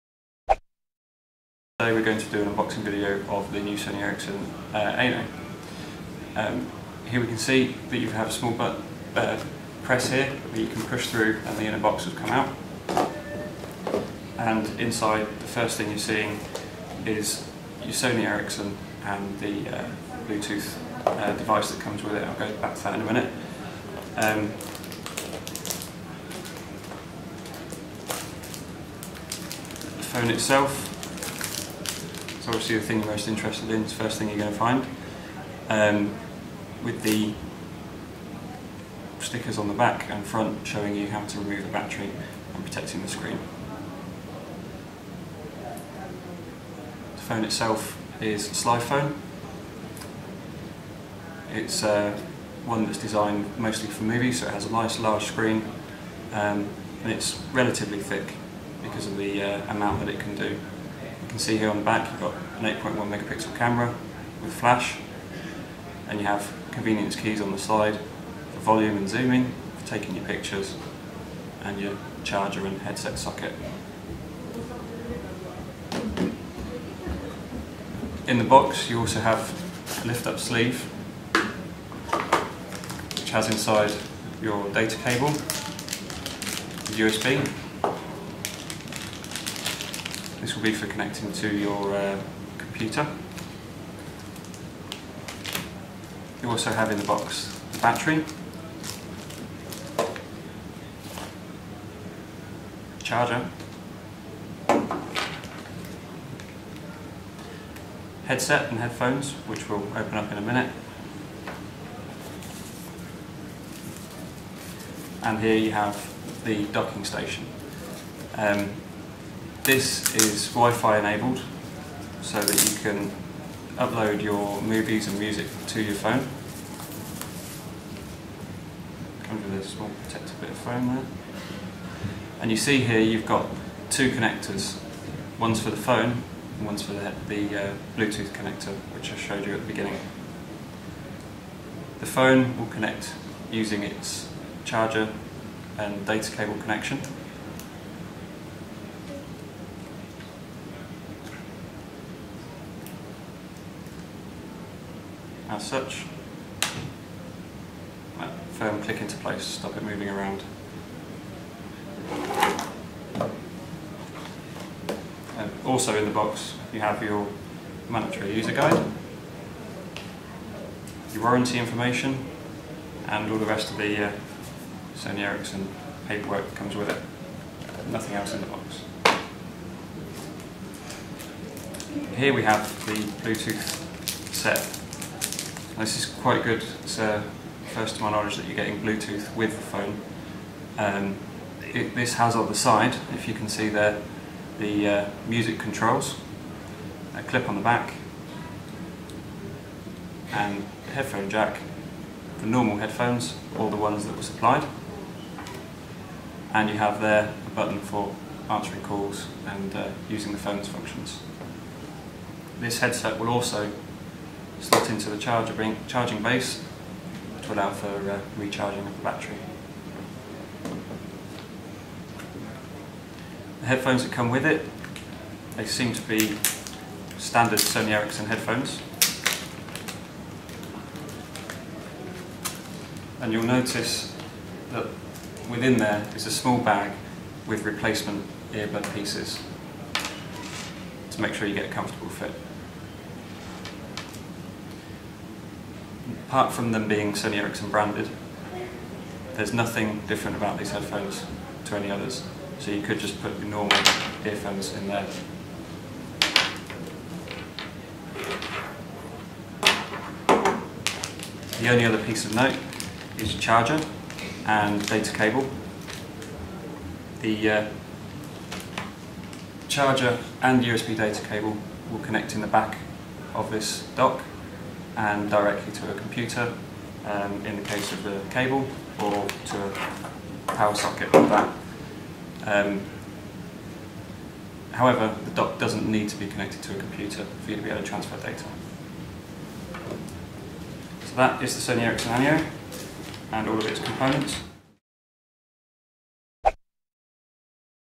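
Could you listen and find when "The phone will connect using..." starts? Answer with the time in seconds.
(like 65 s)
141 s.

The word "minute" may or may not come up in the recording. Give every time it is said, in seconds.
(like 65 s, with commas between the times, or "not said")
23 s, 110 s.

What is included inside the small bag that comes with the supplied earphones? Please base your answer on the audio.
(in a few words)
replacement earbud pieces.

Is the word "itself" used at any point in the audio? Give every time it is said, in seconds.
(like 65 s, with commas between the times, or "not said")
30 s, 47 s.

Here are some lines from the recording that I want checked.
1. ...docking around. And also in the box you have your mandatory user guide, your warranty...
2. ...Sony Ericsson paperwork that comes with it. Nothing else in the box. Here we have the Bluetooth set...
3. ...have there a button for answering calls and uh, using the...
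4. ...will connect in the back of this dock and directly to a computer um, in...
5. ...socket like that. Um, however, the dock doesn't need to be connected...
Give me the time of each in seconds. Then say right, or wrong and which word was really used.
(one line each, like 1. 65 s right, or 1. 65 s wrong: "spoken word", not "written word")
1. 159 s wrong: "moving", not "docking"
2. 174 s right
3. 206 s right
4. 271 s right
5. 280 s right.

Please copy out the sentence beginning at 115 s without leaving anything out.
And here you have the docking station.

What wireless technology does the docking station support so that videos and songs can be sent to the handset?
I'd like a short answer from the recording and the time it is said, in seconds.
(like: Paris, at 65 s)
Wi-Fi, at 120 s.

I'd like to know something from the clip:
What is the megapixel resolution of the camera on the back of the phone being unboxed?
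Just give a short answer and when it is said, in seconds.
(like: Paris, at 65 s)
8.1 megapixel, at 62 s.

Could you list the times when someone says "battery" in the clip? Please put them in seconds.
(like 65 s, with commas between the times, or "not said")
41 s, 97 s, 219 s.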